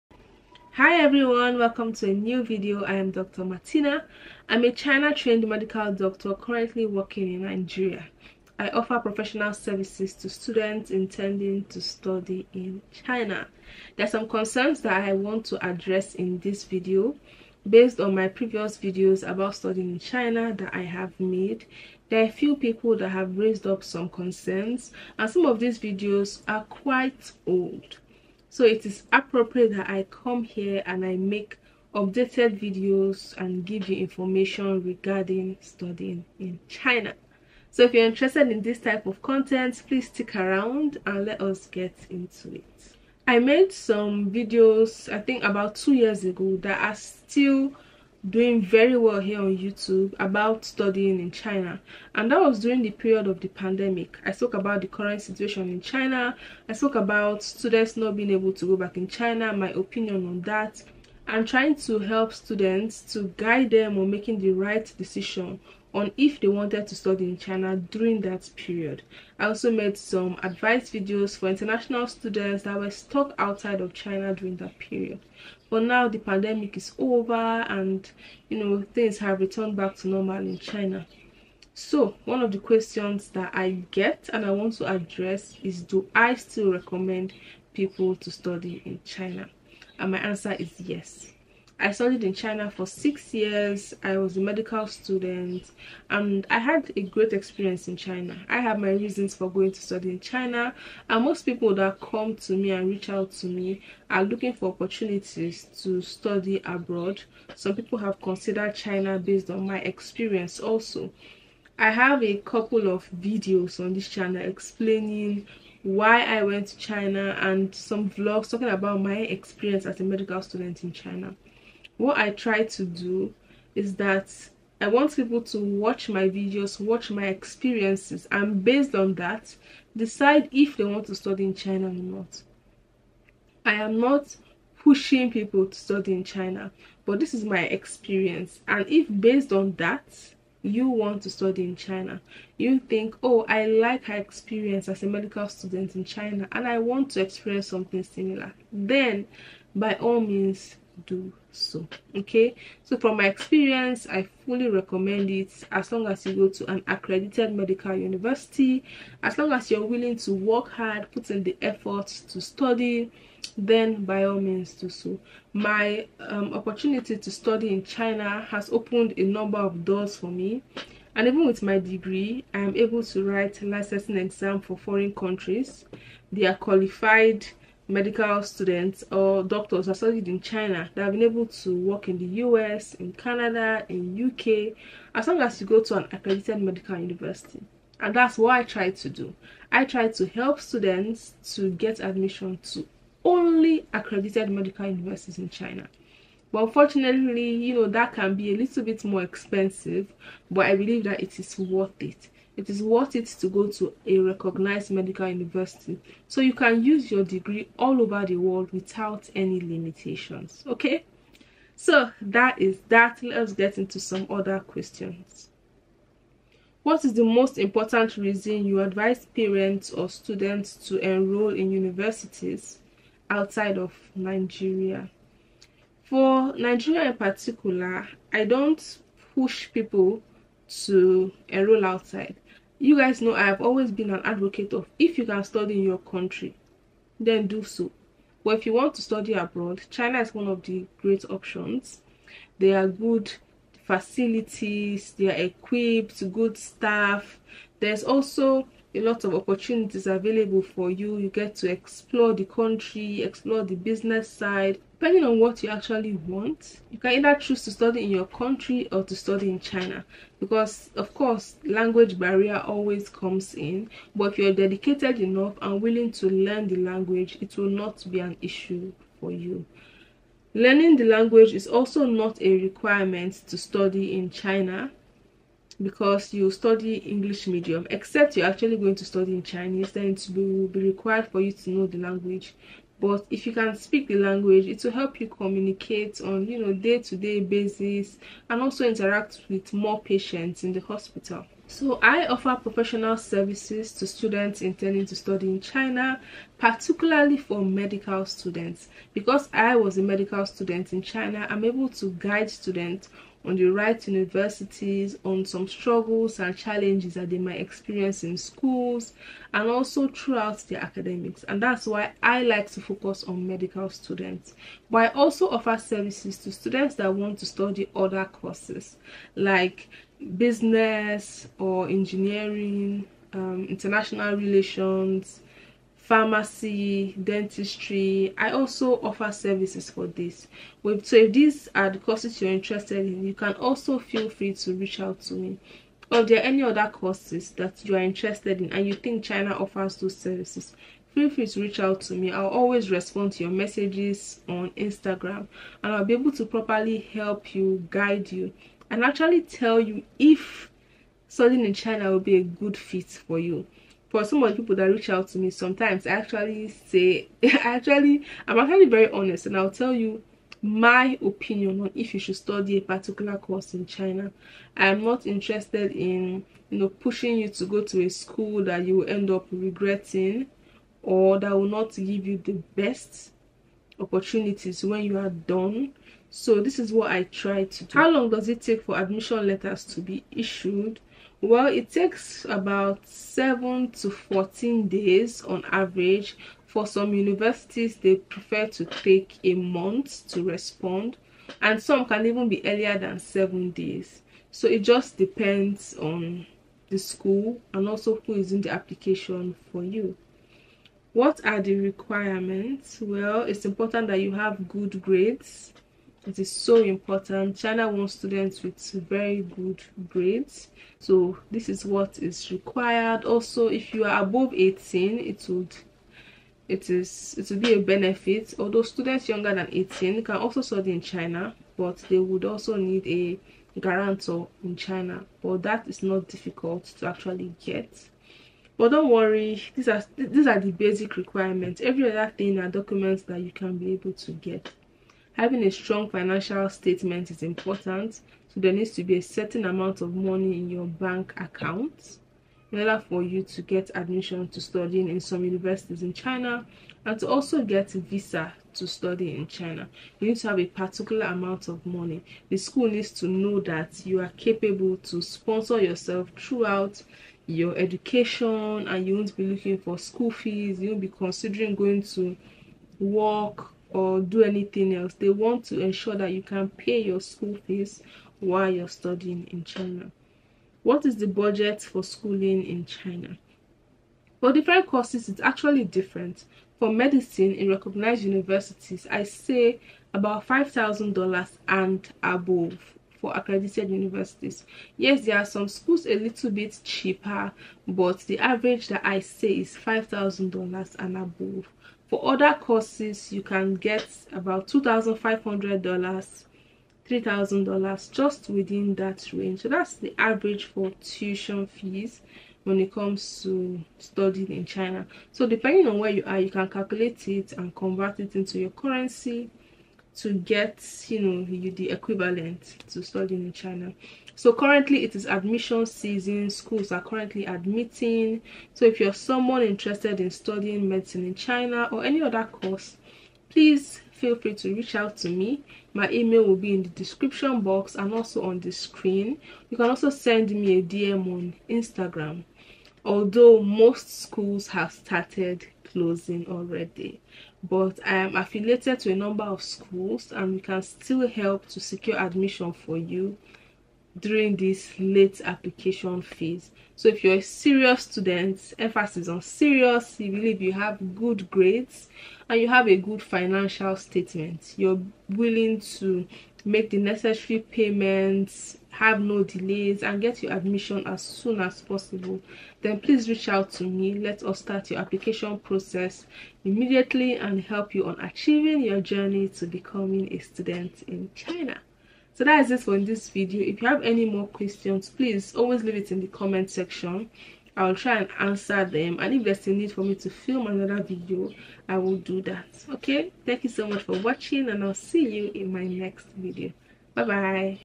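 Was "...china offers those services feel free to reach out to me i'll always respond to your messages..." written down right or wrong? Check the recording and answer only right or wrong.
right.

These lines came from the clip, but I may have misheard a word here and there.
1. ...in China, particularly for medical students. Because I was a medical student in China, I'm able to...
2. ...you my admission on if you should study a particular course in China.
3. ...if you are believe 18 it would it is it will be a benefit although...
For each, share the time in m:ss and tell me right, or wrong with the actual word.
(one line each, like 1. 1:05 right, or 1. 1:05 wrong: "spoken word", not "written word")
1. 4:55 right
2. 5:59 wrong: "opinion", not "admission"
3. 6:53 wrong: "above", not "believe".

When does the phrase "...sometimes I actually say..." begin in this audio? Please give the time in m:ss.
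5:55.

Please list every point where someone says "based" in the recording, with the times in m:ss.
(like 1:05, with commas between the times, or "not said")
0:17, 1:49, 2:08, 2:19.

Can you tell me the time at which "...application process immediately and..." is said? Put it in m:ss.
9:24.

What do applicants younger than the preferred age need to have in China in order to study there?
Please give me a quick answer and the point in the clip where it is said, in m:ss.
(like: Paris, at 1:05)
A guarantor, at 7:03.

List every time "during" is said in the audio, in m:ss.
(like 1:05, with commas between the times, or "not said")
0:52, 1:07, 1:14, 9:04.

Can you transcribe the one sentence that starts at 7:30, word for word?
You need to have a particular amount of money.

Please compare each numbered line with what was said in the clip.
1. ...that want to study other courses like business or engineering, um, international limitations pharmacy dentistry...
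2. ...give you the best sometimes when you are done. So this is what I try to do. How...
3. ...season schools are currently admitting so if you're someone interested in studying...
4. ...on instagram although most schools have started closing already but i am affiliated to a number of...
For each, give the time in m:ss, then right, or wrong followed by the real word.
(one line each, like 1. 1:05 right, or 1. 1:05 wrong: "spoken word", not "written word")
1. 5:16 wrong: "relations", not "limitations"
2. 6:11 wrong: "opportunities", not "sometimes"
3. 8:35 right
4. 8:51 right.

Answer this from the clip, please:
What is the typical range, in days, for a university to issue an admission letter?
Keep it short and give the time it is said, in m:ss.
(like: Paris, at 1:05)
7 to 14 days, at 6:23.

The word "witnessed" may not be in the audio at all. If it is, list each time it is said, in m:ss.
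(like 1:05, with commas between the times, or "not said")
not said.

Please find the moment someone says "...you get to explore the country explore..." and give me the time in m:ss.
4:11.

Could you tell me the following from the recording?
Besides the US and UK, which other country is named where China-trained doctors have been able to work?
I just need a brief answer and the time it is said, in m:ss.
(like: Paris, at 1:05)
Canada, at 3:03.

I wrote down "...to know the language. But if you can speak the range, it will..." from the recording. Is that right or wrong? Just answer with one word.
wrong.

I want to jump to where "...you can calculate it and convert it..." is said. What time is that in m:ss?
8:26.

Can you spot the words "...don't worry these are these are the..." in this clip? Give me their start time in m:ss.
7:08.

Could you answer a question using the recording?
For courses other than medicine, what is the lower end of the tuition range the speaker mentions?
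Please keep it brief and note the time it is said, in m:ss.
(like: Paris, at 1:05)
$2,500, at 8:14.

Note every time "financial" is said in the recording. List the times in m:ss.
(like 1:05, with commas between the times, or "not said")
7:16, 9:13.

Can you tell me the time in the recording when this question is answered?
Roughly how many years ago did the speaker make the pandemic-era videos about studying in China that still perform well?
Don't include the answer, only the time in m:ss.
0:45.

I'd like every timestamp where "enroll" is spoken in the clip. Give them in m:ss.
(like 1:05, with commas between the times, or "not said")
3:40, 3:51.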